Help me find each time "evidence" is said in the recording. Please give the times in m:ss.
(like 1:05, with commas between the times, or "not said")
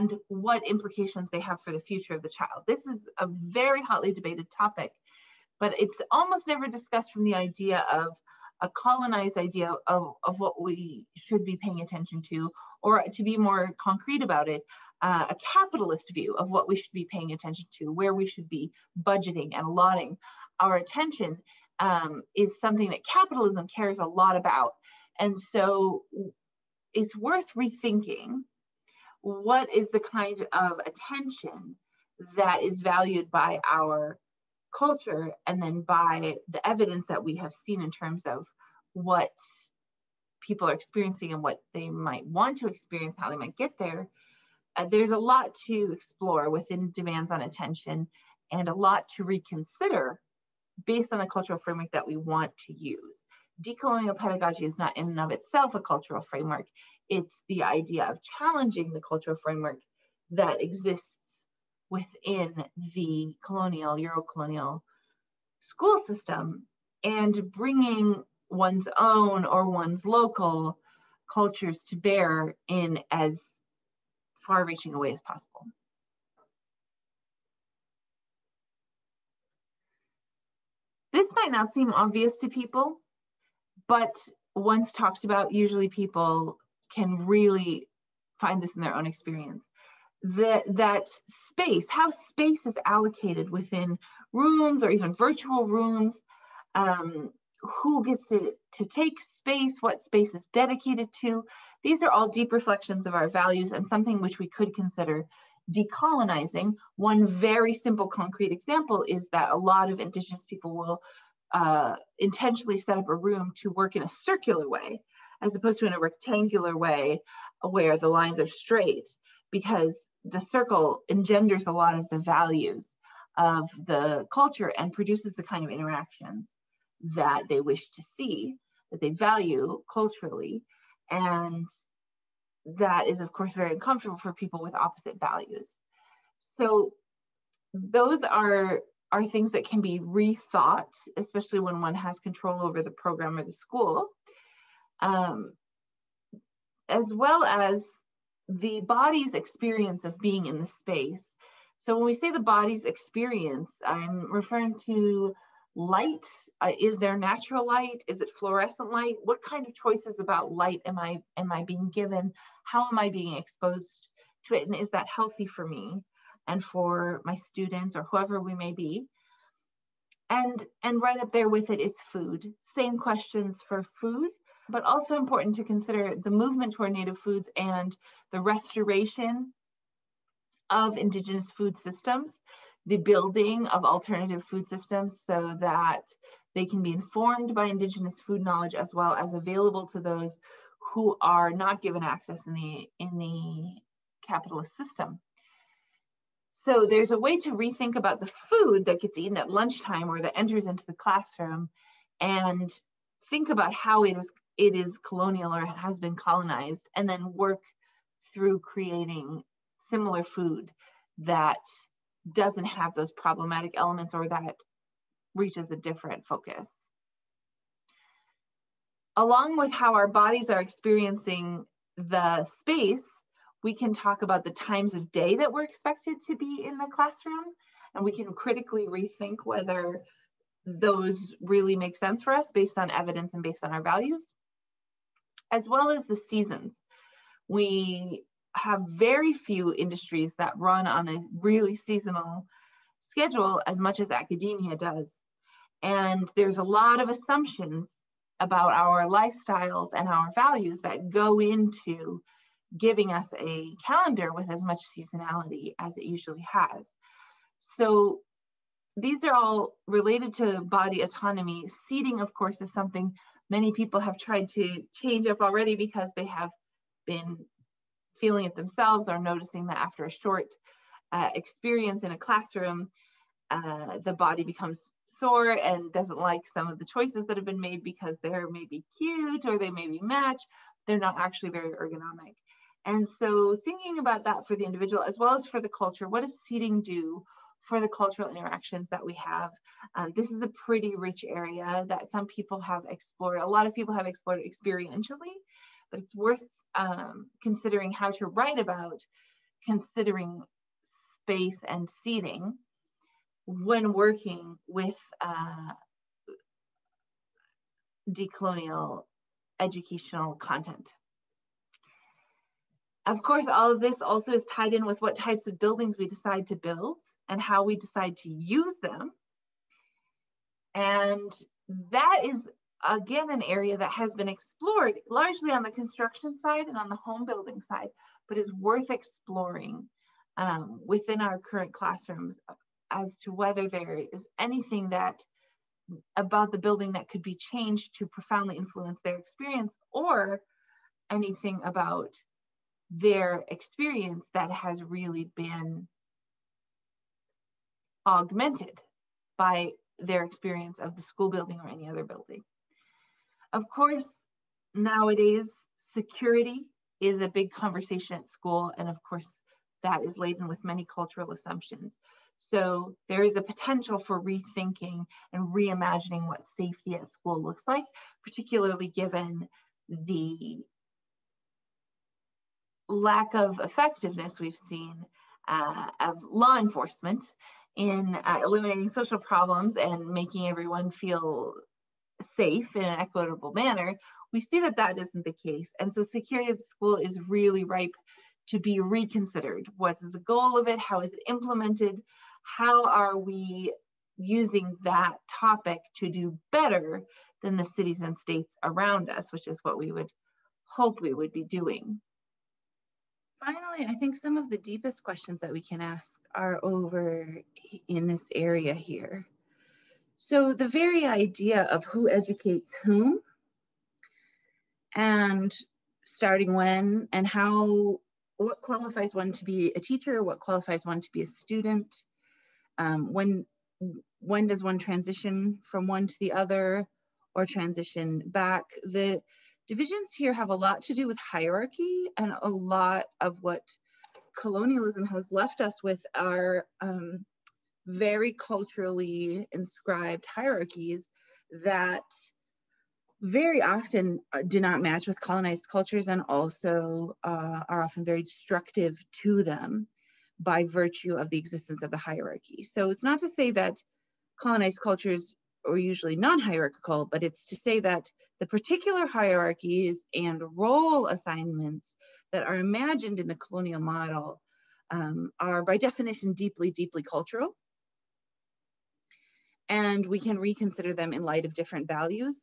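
0:36, 3:52.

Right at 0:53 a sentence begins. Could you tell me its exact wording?
Decolonial pedagogy is not in and of itself a cultural framework.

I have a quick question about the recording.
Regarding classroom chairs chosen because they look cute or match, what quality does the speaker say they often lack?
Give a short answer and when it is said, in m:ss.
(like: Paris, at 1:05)
ergonomic, at 4:41.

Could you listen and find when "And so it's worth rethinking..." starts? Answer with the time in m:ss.
0:25.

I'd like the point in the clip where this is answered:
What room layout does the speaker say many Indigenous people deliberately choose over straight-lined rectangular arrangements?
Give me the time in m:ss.
1:54.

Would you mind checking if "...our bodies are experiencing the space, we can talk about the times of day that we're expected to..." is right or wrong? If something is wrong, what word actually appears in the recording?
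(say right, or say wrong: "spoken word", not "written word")
right.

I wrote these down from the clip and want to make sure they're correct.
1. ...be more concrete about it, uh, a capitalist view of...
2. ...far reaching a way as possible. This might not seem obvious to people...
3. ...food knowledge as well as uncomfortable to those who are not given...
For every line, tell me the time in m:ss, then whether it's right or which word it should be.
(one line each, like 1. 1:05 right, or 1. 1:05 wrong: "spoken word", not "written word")
1. 0:13 right
2. 1:14 right
3. 3:08 wrong: "available", not "uncomfortable".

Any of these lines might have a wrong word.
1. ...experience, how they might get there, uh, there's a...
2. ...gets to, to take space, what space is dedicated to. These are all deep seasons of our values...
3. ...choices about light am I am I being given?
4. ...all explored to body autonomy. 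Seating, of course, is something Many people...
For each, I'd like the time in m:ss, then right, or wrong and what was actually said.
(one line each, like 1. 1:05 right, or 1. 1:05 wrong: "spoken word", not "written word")
1. 0:42 right
2. 1:38 wrong: "reflections", not "seasons"
3. 2:39 right
4. 4:19 wrong: "related", not "explored".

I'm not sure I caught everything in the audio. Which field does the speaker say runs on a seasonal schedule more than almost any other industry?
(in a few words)
academia.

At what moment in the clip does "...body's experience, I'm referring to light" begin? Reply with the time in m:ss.
2:32.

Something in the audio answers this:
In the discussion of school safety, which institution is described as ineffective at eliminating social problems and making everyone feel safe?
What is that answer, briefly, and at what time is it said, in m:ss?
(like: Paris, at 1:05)
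law enforcement, at 6:16.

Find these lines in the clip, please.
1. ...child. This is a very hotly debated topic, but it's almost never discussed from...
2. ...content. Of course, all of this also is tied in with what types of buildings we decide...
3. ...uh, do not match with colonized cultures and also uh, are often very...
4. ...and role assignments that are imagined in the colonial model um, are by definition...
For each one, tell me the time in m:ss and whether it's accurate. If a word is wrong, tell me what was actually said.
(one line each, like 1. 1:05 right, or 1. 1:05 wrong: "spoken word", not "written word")
1. 0:02 right
2. 5:10 right
3. 7:24 right
4. 7:40 right.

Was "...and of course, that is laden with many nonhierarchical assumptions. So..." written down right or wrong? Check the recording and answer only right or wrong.
wrong.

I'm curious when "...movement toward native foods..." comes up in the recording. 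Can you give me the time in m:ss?
2:56.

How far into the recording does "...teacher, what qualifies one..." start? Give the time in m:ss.
6:59.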